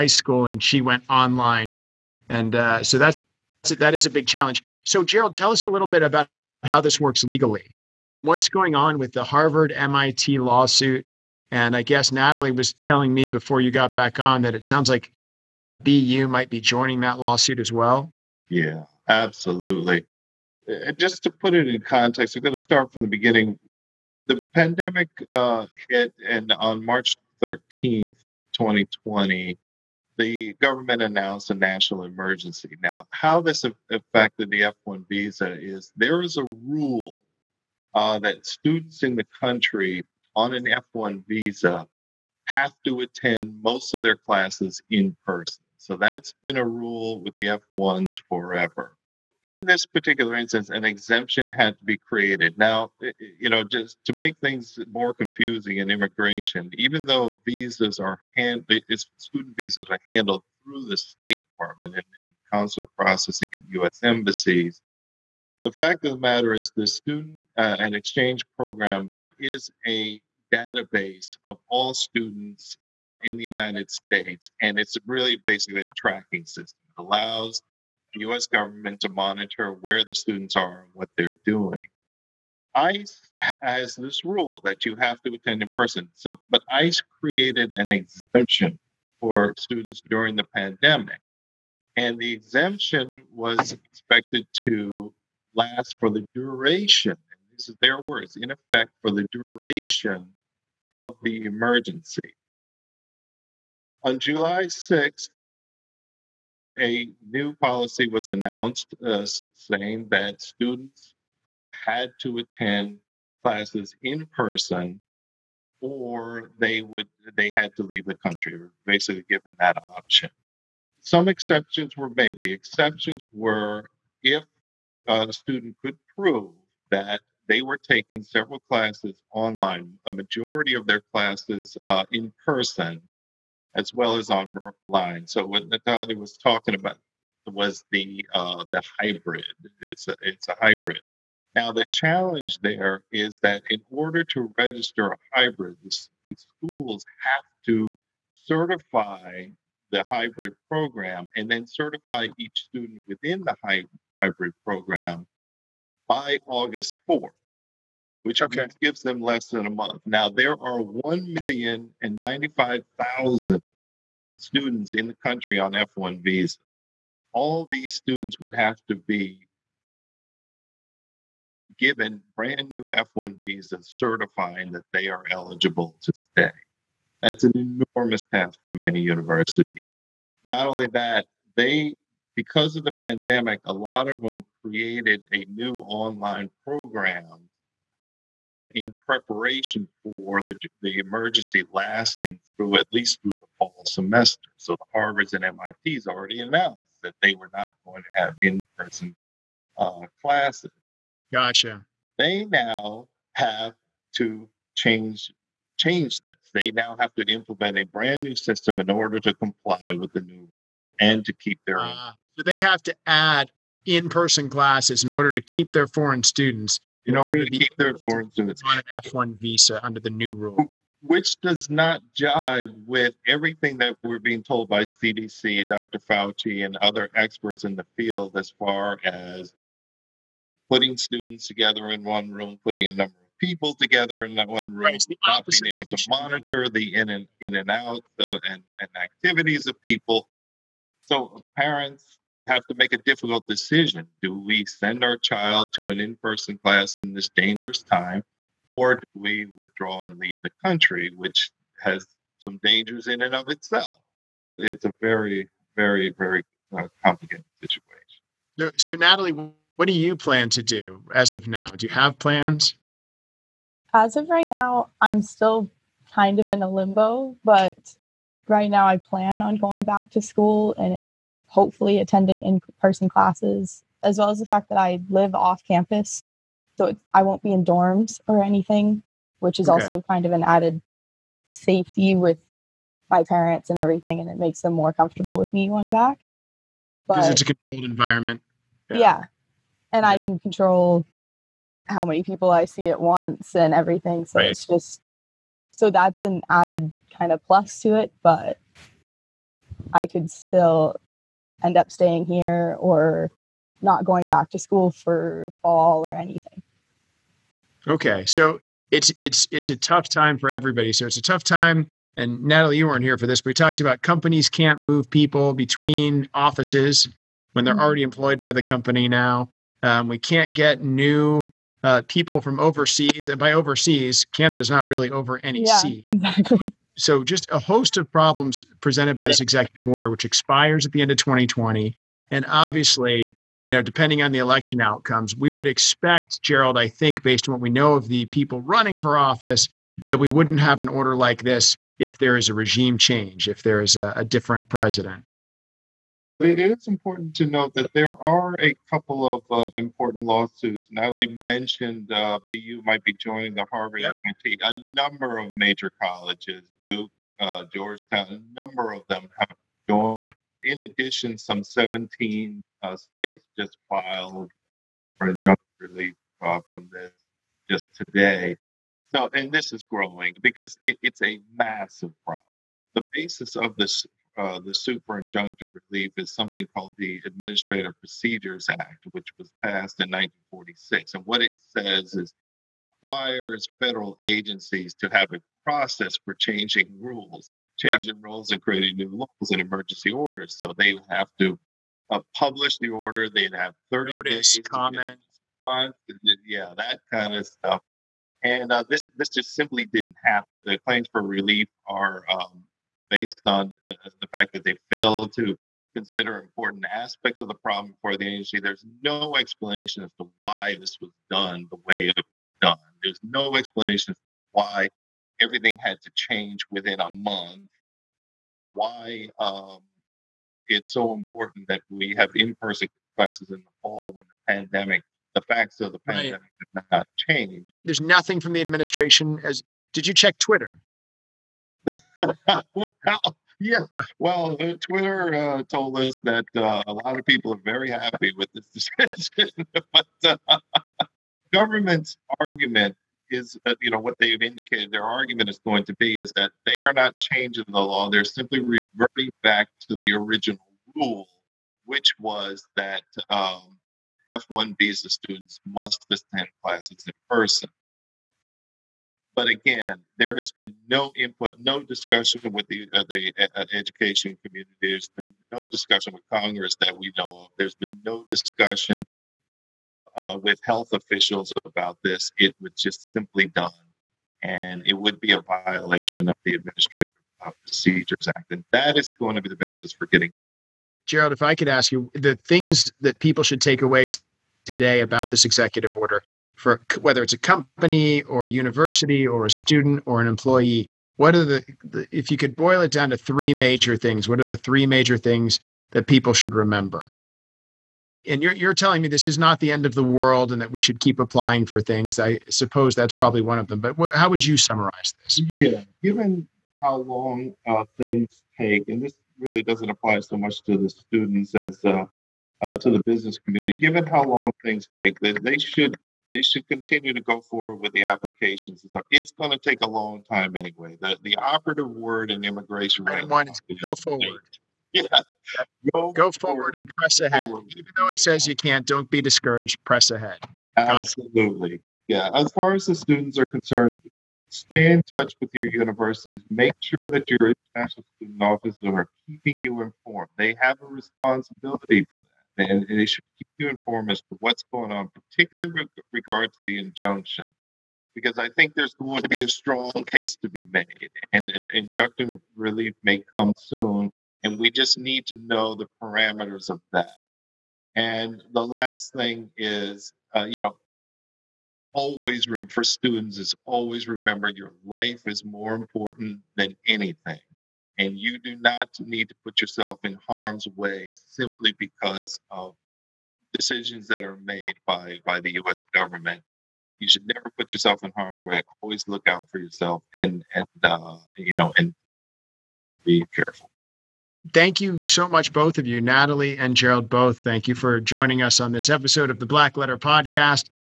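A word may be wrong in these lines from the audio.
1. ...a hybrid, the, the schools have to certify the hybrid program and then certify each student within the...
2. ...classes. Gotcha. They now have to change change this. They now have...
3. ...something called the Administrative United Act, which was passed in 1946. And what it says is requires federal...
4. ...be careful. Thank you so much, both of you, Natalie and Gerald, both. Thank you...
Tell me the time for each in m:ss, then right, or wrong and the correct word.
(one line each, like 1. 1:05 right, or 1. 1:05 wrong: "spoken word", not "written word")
1. 2:25 right
2. 3:20 right
3. 6:16 wrong: "Procedures", not "United"
4. 9:43 right.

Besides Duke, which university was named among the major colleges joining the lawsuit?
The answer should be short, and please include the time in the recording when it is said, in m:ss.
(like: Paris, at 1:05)
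Georgetown, at 5:57.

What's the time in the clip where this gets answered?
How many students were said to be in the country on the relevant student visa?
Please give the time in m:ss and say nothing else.
2:40.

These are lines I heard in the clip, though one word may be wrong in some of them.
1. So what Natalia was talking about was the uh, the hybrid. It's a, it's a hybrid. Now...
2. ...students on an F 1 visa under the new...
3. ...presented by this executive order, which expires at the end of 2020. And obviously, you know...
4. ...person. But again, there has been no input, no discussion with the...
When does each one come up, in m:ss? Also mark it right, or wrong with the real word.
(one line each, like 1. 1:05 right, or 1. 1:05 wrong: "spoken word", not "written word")
1. 2:15 right
2. 3:38 right
3. 5:28 right
4. 7:37 right.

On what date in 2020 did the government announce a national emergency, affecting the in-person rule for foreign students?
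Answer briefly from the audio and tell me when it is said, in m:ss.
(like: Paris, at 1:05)
March 13th, at 0:26.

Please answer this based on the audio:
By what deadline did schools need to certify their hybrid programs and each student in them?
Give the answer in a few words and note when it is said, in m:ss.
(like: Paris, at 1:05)
August 4th, at 2:36.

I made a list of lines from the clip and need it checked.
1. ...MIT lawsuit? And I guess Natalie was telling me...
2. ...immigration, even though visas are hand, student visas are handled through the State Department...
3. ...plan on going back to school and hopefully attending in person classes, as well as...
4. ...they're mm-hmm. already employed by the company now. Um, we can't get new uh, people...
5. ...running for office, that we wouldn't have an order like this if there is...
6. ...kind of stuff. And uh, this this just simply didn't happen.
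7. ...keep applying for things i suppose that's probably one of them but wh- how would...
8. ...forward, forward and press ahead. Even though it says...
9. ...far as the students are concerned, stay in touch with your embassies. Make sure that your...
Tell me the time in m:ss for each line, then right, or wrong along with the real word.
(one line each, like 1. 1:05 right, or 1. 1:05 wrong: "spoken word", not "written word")
1. 0:09 right
2. 0:55 right
3. 4:28 right
4. 5:17 right
5. 5:38 right
6. 6:37 right
7. 8:20 right
8. 8:46 right
9. 8:52 wrong: "universities", not "embassies".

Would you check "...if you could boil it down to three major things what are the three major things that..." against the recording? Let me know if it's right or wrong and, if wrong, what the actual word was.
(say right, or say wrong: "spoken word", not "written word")
right.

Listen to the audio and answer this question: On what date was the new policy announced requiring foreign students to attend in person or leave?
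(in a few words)
July 6th.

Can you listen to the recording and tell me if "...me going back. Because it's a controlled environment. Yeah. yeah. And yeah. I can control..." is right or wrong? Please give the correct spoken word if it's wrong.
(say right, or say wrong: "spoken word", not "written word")
right.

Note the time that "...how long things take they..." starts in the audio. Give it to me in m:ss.
8:34.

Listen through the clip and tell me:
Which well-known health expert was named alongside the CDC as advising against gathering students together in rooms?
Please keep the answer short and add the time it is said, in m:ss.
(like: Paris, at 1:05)
Dr. Fauci, at 3:45.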